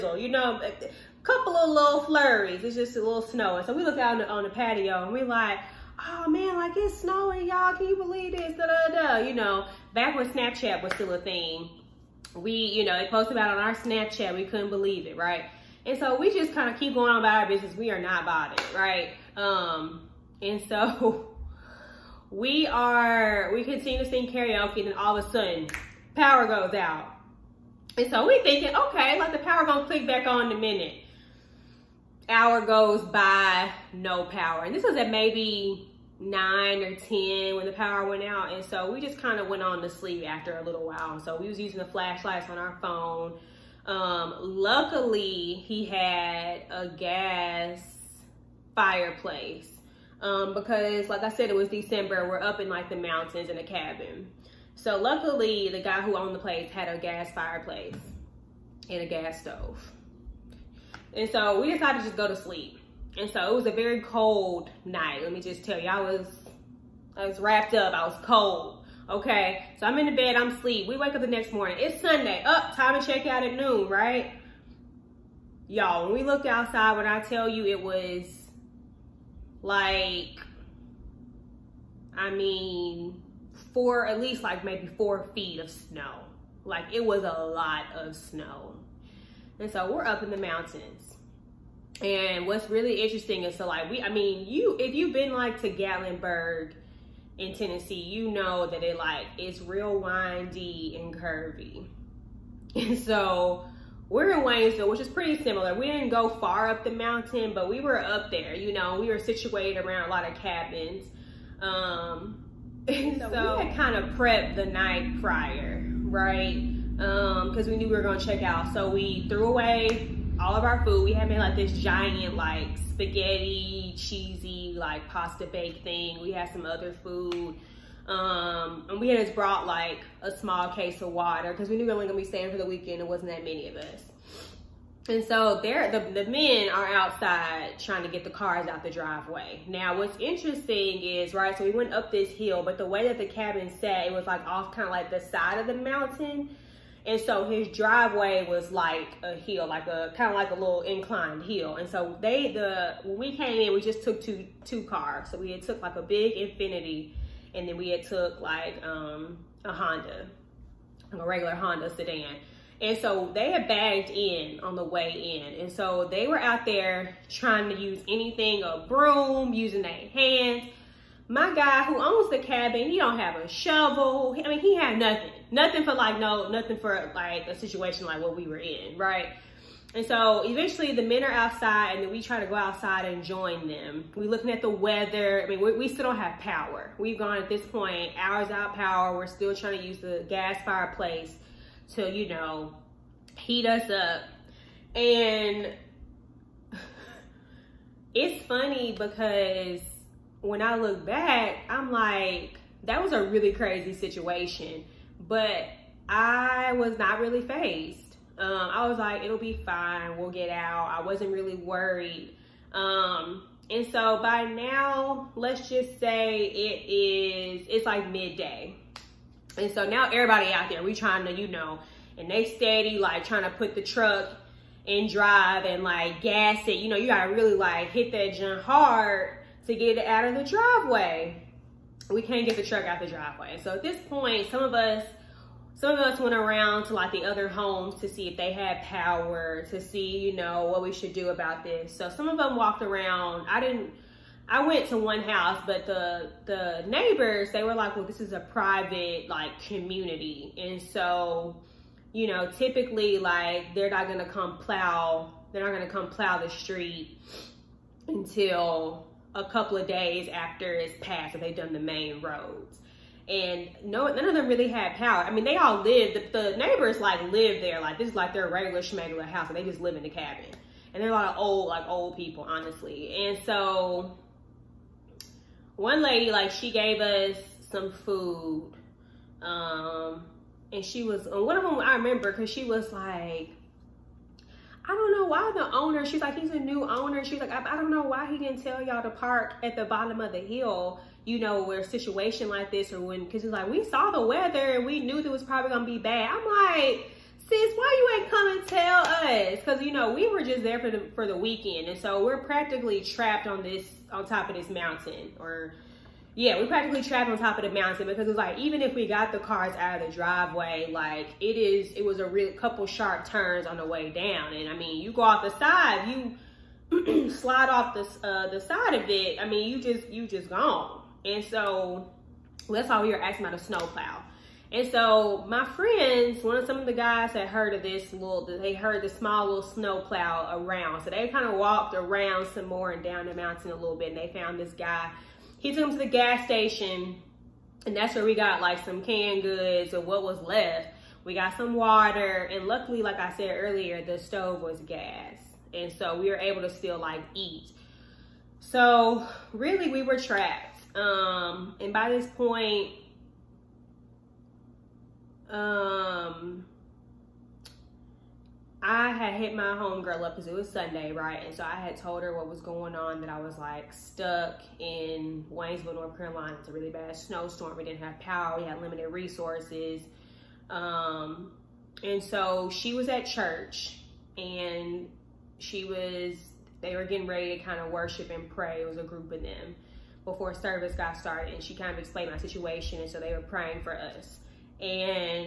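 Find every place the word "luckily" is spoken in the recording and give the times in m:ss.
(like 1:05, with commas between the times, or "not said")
0:44, 0:54, 5:42.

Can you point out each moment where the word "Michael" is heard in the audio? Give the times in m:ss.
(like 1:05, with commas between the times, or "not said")
not said.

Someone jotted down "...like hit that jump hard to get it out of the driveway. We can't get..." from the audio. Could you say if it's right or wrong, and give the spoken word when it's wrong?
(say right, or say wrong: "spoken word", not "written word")
right.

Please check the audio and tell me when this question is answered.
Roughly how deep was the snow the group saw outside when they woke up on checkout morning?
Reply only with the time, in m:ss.
1:24.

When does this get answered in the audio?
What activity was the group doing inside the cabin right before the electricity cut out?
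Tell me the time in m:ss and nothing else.
0:24.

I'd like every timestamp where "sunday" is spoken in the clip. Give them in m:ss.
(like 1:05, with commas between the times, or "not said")
1:11, 6:00.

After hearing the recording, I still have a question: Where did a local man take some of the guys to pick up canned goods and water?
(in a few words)
gas station.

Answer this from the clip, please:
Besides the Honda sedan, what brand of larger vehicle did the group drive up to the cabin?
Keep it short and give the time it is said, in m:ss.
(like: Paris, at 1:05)
Infiniti, at 2:36.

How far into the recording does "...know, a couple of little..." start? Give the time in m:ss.
0:00.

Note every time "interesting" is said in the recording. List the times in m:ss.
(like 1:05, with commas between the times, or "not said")
1:33, 2:20.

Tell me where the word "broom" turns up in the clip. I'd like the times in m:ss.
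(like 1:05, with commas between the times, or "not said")
2:48.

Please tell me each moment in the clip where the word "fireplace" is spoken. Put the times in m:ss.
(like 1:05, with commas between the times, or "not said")
0:48, 0:57, 3:10.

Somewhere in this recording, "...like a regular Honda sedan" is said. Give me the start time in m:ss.
2:41.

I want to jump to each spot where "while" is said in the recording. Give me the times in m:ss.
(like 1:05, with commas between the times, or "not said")
0:40.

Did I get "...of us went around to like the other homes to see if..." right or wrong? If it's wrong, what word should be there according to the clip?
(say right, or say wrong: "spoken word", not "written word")
right.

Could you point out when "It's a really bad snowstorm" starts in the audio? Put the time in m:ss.
6:06.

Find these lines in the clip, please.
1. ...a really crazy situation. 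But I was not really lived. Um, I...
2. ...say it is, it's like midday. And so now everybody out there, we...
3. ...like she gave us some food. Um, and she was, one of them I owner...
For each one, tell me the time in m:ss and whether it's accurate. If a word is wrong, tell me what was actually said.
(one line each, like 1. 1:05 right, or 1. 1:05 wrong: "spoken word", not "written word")
1. 3:23 wrong: "fazed", not "lived"
2. 3:35 right
3. 4:36 wrong: "remember", not "owner".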